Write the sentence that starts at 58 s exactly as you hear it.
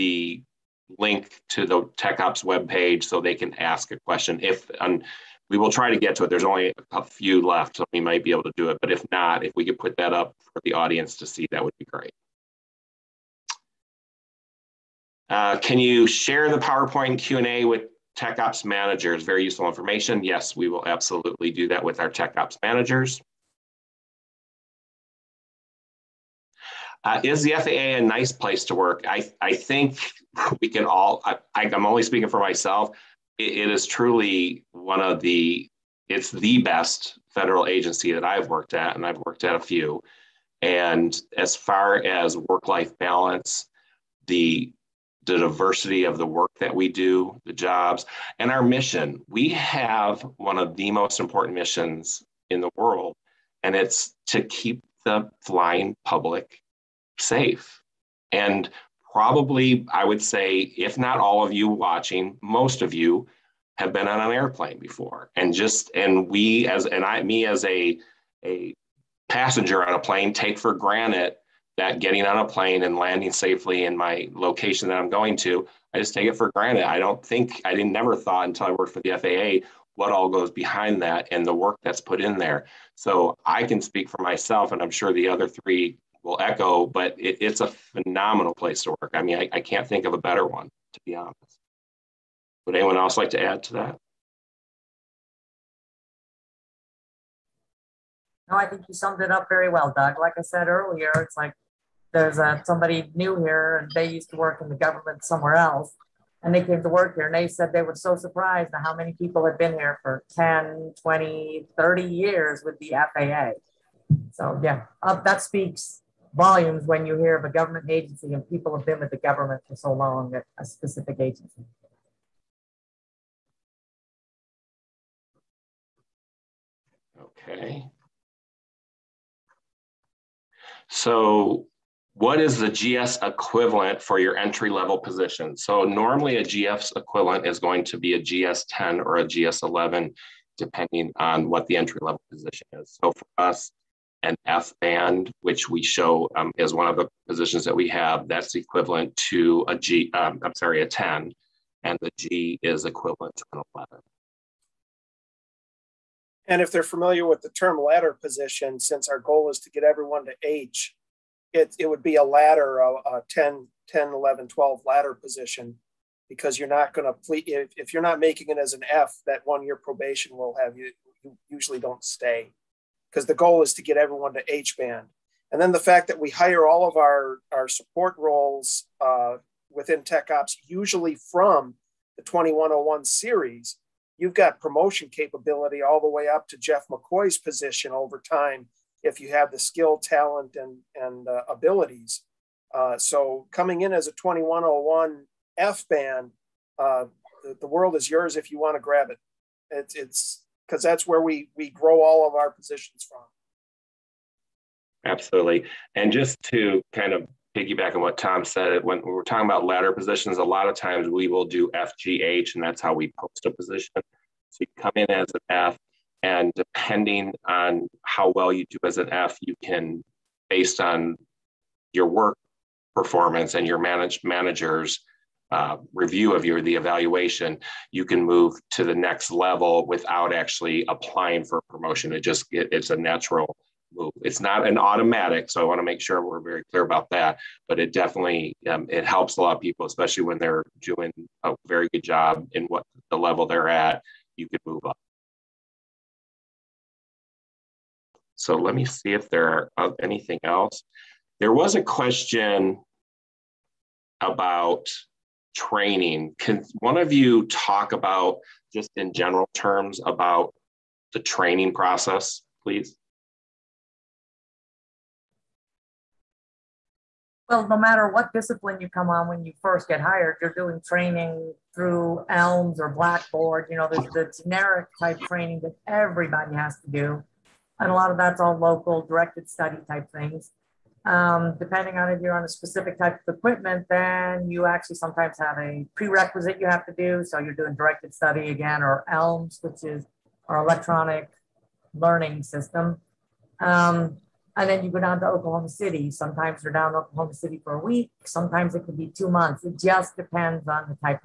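And probably, I would say, if not all of you watching, most of you have been on an airplane before.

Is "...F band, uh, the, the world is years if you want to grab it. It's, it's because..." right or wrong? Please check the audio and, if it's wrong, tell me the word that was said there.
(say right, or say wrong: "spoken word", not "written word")
wrong: "yours", not "years".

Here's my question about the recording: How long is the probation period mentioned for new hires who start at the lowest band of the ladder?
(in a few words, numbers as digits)
1 year.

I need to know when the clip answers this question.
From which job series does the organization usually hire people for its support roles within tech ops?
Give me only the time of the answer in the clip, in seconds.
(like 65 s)
182 s.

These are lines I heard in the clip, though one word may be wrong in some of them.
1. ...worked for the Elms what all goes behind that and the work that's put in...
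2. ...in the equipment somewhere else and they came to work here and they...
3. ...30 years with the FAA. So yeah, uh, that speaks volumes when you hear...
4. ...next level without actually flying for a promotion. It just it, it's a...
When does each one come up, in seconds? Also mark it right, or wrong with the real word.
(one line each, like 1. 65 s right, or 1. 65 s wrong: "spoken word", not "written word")
1. 78 s wrong: "FAA", not "Elms"
2. 104 s wrong: "government", not "equipment"
3. 111 s right
4. 228 s wrong: "applying", not "flying".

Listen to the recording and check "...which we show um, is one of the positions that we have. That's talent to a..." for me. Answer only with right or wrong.
wrong.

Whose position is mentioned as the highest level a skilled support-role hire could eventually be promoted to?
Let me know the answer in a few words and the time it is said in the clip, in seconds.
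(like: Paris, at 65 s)
Jeff McCoy, at 186 s.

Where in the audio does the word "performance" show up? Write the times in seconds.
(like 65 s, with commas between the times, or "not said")
222 s.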